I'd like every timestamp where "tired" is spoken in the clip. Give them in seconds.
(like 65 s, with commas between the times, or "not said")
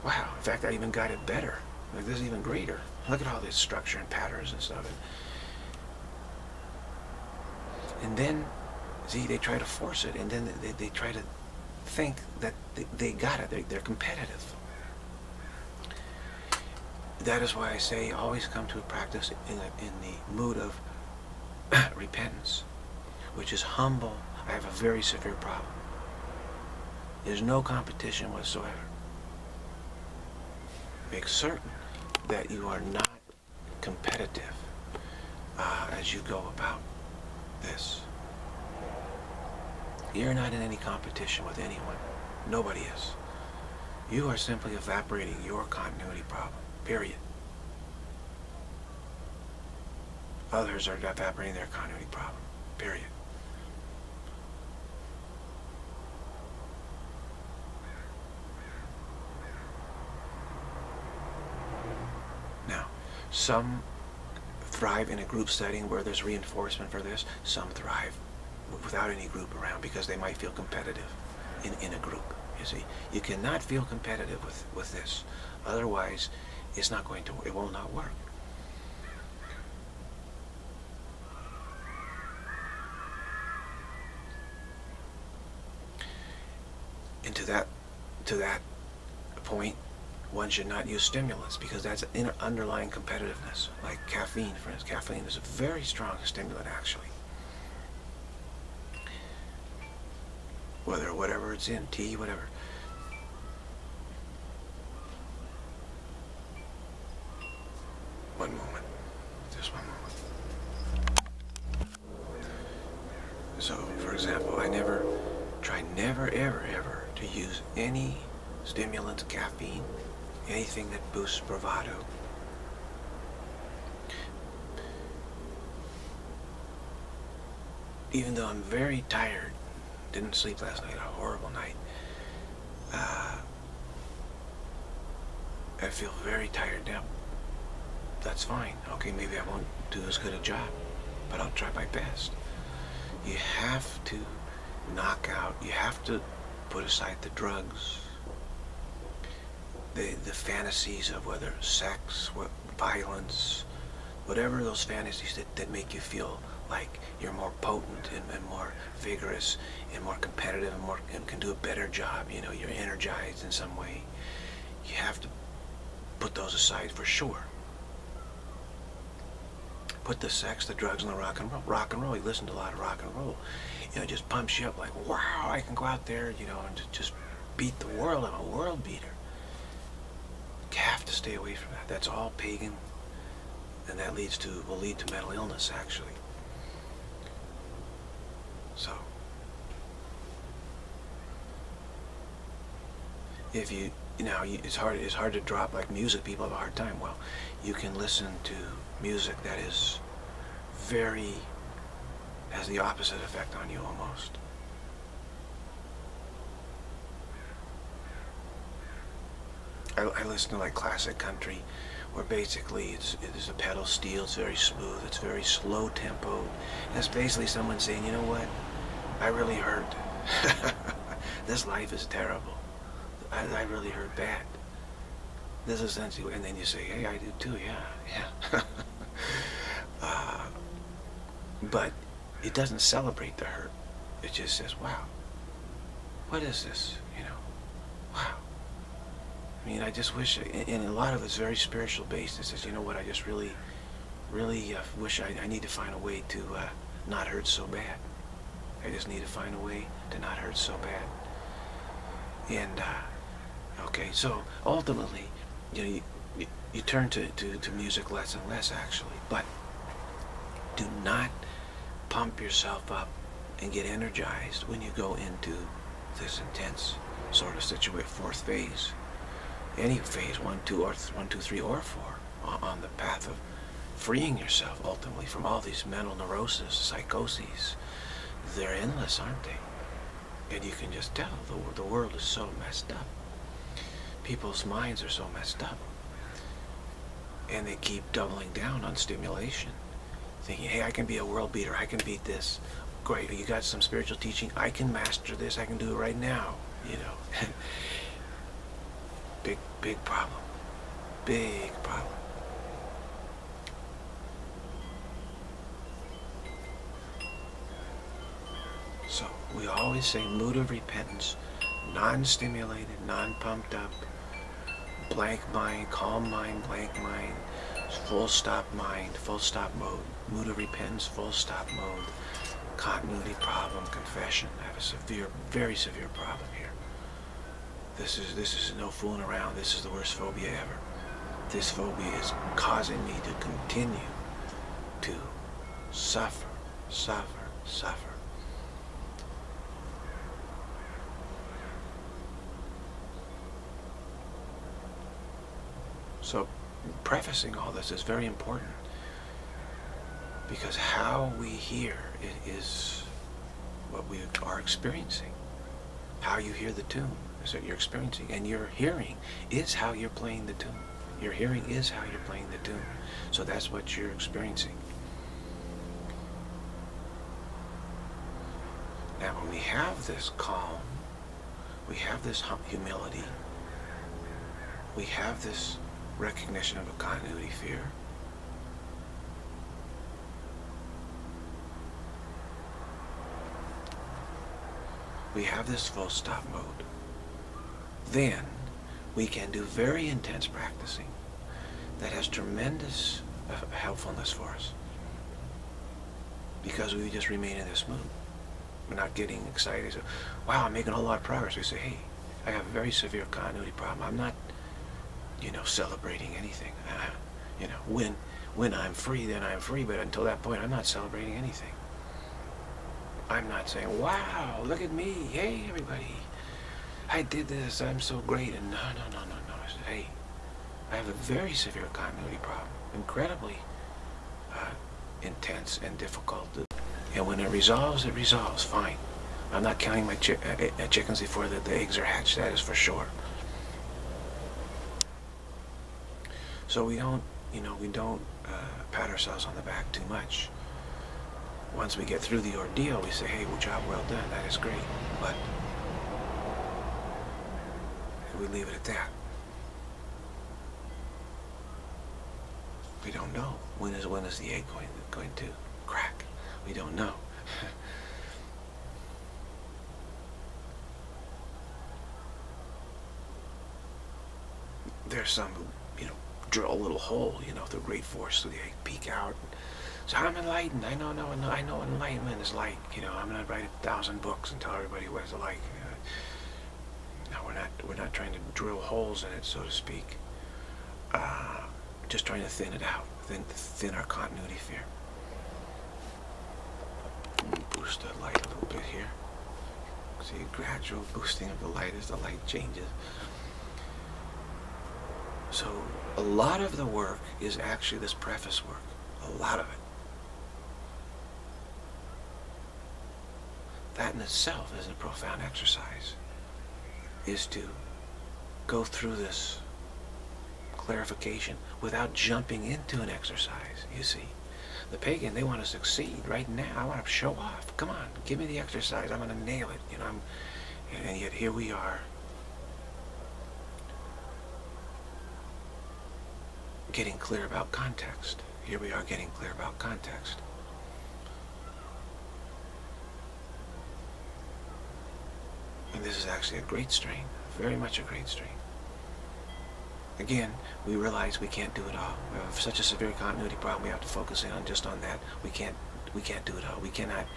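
129 s, 136 s.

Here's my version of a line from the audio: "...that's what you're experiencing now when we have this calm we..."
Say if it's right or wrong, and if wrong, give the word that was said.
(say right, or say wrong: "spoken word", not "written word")
right.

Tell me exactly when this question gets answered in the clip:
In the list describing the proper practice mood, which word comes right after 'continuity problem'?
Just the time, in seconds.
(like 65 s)
323 s.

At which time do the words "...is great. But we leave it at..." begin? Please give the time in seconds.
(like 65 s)
444 s.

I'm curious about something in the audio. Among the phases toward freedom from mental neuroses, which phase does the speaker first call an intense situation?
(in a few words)
fourth phase.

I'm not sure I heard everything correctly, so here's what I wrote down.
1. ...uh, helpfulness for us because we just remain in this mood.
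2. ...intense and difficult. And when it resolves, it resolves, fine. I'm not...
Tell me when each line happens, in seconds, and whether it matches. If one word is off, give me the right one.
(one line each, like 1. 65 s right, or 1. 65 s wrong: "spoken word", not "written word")
1. 393 s right
2. 425 s right.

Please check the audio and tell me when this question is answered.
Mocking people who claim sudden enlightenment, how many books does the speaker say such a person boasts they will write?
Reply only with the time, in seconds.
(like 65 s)
473 s.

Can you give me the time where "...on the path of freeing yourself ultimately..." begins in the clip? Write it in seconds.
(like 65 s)
272 s.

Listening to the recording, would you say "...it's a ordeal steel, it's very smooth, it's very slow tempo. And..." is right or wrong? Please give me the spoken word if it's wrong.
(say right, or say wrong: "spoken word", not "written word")
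wrong: "pedal", not "ordeal".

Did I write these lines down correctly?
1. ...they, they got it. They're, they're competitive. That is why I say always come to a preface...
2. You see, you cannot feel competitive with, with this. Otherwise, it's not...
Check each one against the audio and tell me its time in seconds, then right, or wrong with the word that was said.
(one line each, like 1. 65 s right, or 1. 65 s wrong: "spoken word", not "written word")
1. 12 s wrong: "practice", not "preface"
2. 72 s right.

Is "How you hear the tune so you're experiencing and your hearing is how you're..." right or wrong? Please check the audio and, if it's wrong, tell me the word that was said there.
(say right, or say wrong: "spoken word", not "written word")
right.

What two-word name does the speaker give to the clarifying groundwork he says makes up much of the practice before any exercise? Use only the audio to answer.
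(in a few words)
preface work.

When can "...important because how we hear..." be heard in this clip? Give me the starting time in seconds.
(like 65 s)
348 s.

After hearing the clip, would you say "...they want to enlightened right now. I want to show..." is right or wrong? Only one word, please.
wrong.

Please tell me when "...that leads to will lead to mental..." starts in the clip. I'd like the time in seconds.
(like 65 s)
183 s.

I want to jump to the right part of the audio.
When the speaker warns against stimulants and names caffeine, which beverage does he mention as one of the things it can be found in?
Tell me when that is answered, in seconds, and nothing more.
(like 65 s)
101 s.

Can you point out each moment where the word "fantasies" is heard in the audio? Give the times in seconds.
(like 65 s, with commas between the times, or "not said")
150 s, 154 s.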